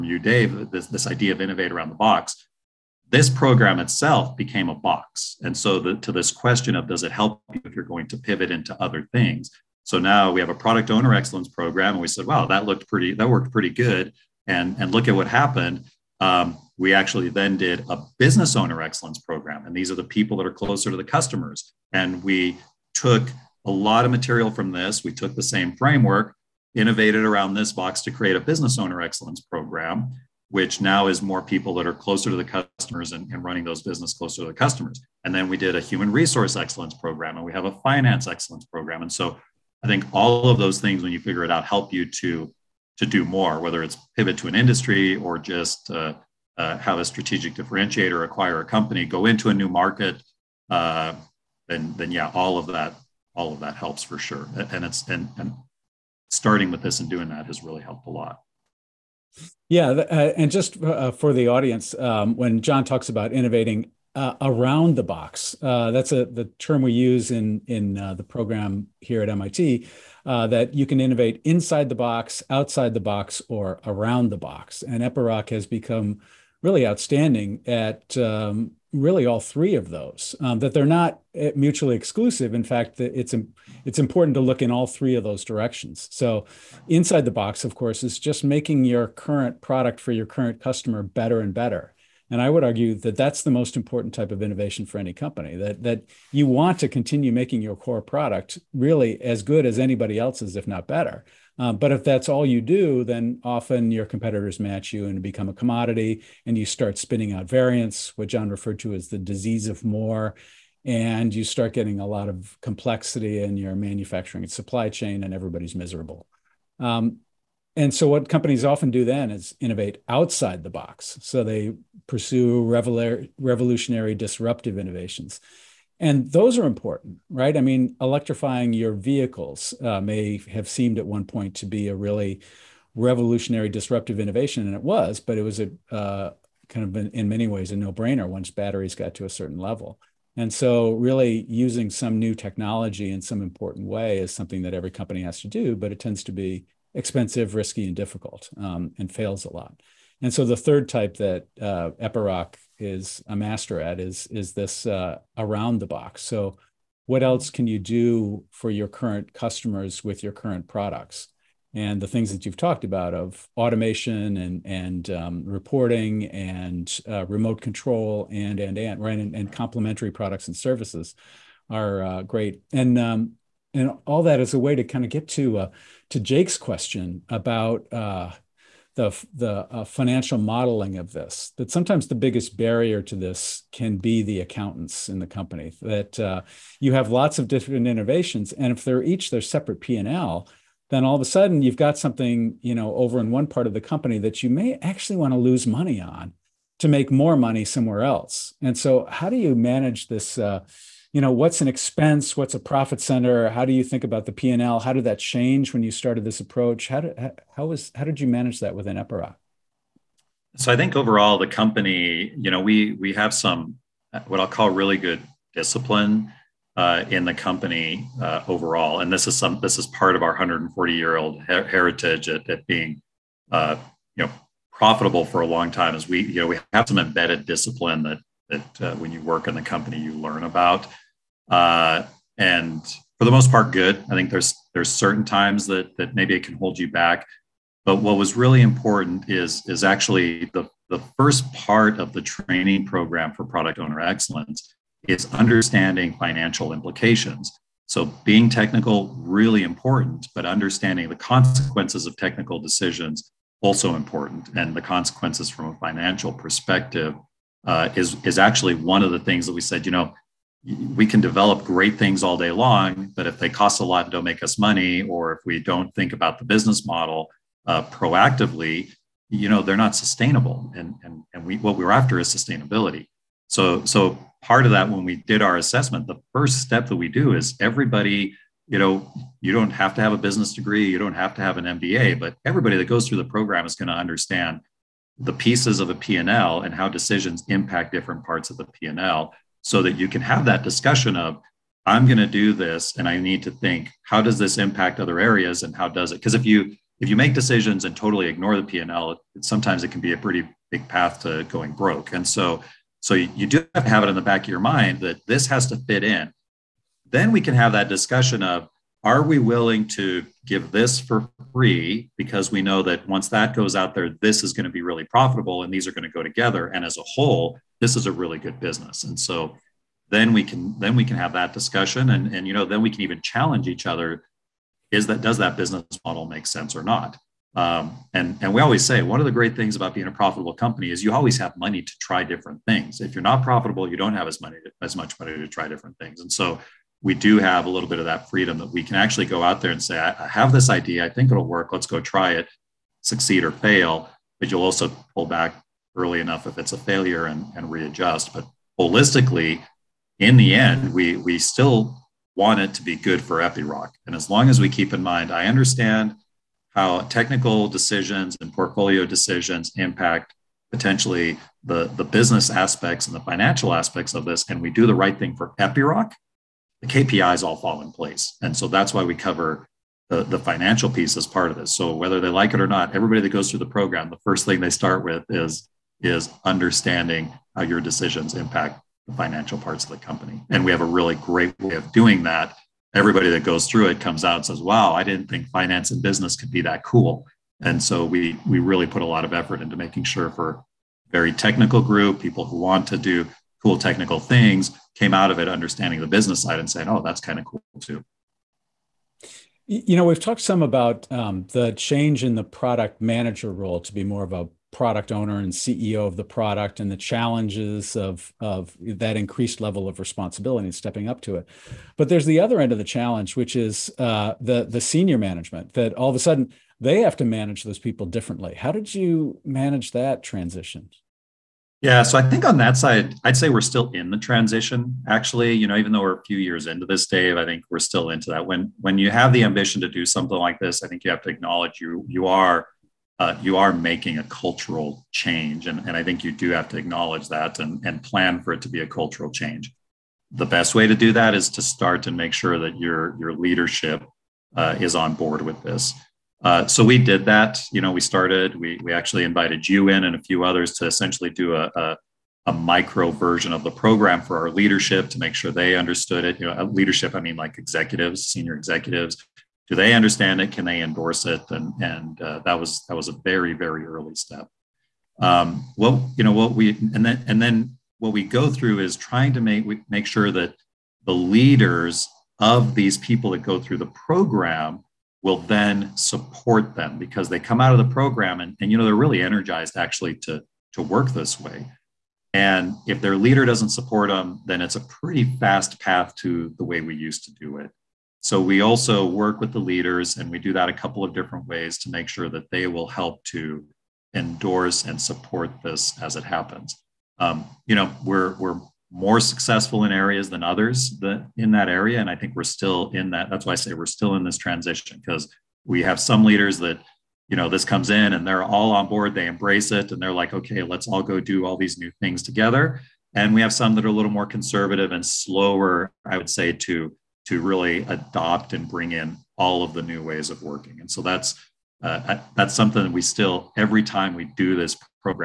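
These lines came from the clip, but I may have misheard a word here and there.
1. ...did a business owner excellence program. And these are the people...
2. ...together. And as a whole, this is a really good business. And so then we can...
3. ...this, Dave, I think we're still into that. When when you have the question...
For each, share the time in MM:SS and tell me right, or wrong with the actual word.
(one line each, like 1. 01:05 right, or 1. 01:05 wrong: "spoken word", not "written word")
1. 00:17 right
2. 05:16 right
3. 07:06 wrong: "ambition", not "question".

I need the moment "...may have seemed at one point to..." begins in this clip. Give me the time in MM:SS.
02:09.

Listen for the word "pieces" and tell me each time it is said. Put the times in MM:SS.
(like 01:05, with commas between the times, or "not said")
04:45, 06:10.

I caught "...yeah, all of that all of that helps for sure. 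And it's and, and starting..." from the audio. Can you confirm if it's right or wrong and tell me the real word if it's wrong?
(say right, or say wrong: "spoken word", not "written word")
right.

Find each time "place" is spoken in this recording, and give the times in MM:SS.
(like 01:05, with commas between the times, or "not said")
06:07.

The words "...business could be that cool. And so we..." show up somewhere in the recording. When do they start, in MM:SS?
06:25.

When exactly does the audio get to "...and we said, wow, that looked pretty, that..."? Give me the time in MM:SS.
00:11.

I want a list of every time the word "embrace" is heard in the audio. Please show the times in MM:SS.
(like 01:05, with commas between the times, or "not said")
08:29.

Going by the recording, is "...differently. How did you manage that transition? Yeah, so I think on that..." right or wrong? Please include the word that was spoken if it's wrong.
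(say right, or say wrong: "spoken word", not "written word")
right.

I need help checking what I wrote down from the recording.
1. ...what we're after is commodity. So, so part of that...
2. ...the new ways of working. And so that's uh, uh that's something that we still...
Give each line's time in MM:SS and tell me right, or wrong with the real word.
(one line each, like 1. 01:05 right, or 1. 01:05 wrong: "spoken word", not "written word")
1. 04:31 wrong: "sustainability", not "commodity"
2. 08:39 right.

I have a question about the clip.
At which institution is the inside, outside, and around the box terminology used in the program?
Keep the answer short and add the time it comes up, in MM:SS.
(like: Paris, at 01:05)
MIT, at 01:09.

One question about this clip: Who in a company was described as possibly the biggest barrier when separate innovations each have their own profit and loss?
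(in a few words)
the accountants.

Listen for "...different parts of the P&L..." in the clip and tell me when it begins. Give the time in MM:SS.
04:47.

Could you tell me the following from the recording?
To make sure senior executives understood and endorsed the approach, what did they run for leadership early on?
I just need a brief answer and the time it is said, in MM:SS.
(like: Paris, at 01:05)
a micro version of the program, at 07:32.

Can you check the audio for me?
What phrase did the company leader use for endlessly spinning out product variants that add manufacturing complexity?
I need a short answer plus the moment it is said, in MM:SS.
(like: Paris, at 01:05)
the disease of more, at 01:49.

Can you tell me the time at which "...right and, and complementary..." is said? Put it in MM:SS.
02:49.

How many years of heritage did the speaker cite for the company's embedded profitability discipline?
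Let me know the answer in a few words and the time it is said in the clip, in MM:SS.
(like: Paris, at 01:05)
140, at 03:40.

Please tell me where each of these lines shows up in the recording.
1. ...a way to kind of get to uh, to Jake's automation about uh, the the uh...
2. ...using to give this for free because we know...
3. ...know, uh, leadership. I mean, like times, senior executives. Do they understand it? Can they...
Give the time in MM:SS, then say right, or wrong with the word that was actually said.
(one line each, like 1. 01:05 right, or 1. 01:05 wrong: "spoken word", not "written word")
1. 02:54 wrong: "question", not "automation"
2. 05:09 wrong: "willing", not "using"
3. 07:36 wrong: "executives", not "times".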